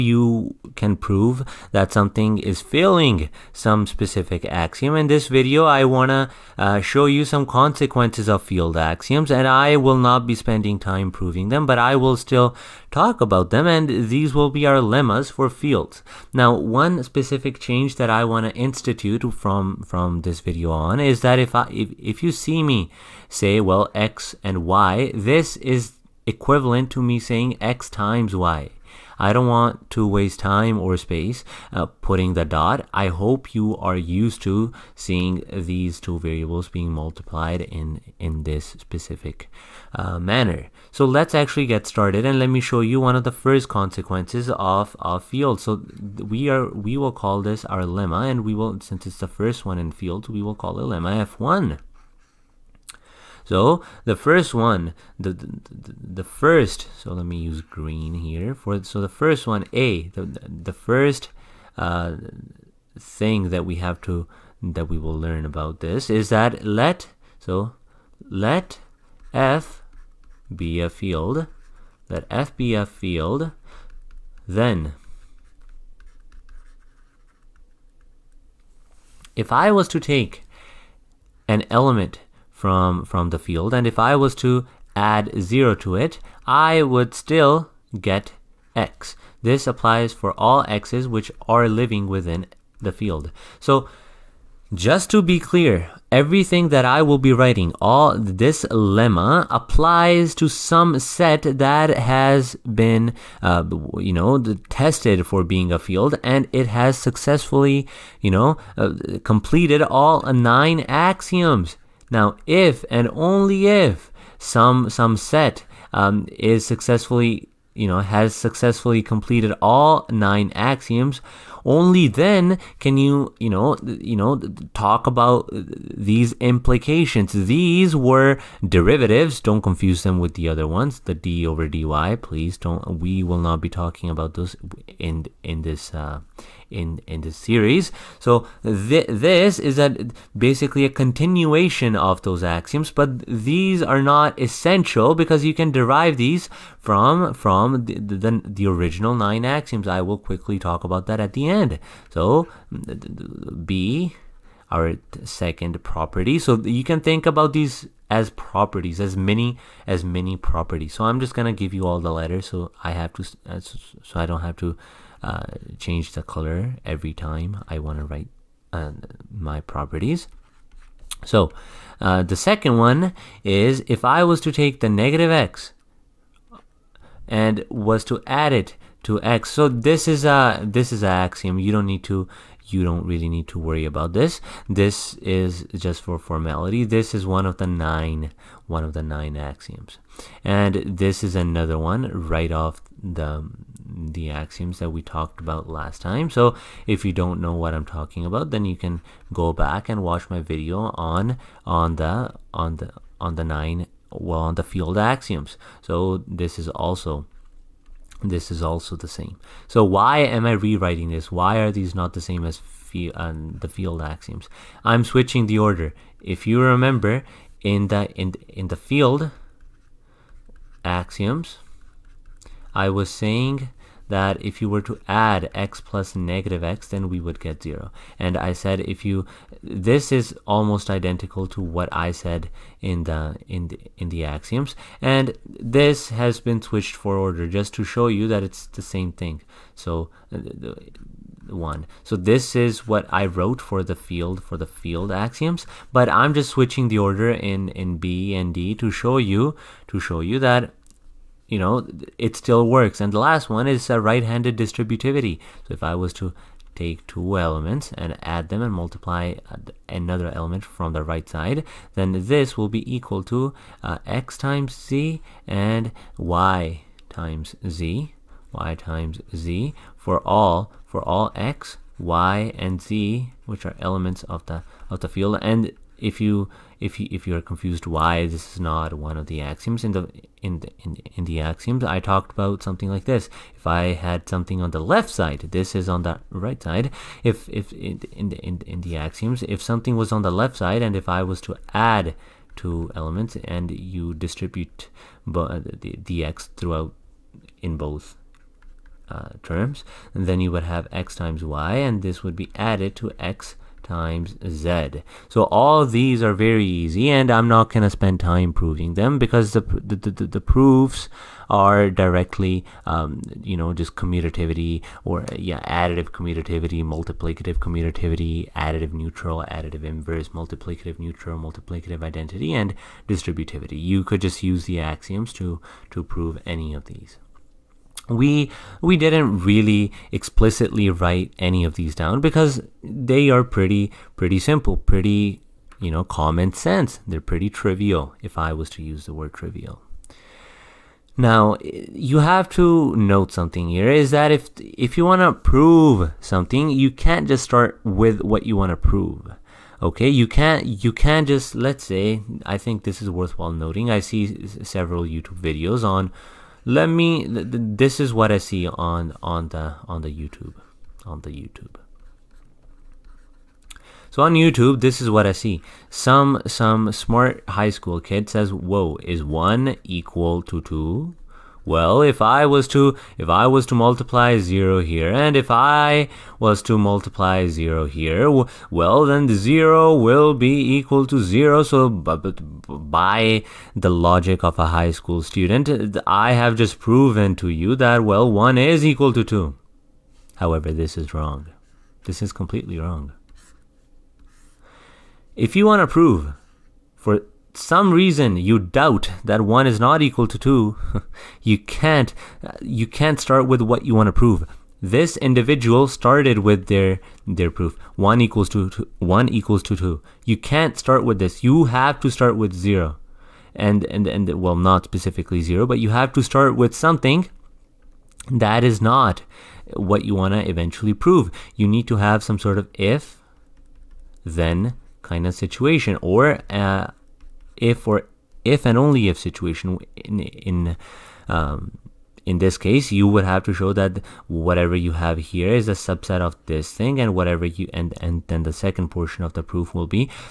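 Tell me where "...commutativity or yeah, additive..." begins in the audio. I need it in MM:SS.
05:13.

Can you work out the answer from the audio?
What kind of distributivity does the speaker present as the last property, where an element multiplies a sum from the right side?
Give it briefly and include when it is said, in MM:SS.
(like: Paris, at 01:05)
Right-handed distributivity, at 04:13.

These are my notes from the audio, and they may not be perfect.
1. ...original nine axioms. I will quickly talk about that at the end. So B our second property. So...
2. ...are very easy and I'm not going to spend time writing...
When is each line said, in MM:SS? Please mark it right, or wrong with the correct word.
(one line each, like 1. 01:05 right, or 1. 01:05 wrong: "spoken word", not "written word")
1. 02:28 right
2. 05:06 wrong: "proving", not "writing".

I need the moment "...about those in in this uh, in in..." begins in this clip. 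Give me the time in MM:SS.
02:14.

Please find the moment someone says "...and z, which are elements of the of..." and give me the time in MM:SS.
04:32.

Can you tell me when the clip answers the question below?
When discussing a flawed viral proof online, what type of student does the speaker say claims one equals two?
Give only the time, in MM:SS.
06:06.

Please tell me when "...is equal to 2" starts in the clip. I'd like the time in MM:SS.
06:28.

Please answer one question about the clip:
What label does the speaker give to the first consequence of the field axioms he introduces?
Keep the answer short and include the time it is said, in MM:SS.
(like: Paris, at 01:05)
Lemma F1, at 00:50.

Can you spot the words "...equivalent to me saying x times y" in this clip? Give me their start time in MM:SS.
00:26.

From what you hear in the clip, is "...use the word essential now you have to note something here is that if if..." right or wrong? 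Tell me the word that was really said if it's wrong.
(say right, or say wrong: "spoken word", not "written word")
wrong: "trivial", not "essential".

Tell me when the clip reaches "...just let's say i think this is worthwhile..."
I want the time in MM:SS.
05:51.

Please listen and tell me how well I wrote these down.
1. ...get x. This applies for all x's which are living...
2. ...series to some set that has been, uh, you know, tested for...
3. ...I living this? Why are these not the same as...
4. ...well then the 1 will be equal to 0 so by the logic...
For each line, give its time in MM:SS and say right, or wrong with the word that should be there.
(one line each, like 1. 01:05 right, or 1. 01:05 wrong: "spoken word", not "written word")
1. 01:27 right
2. 01:39 wrong: "applies", not "series"
3. 03:30 wrong: "rewriting", not "living"
4. 06:18 wrong: "0", not "1".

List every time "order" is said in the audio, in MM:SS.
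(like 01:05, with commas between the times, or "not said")
03:35, 03:57, 04:06.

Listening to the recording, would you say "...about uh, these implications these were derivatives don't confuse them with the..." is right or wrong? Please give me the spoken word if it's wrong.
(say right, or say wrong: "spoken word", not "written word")
right.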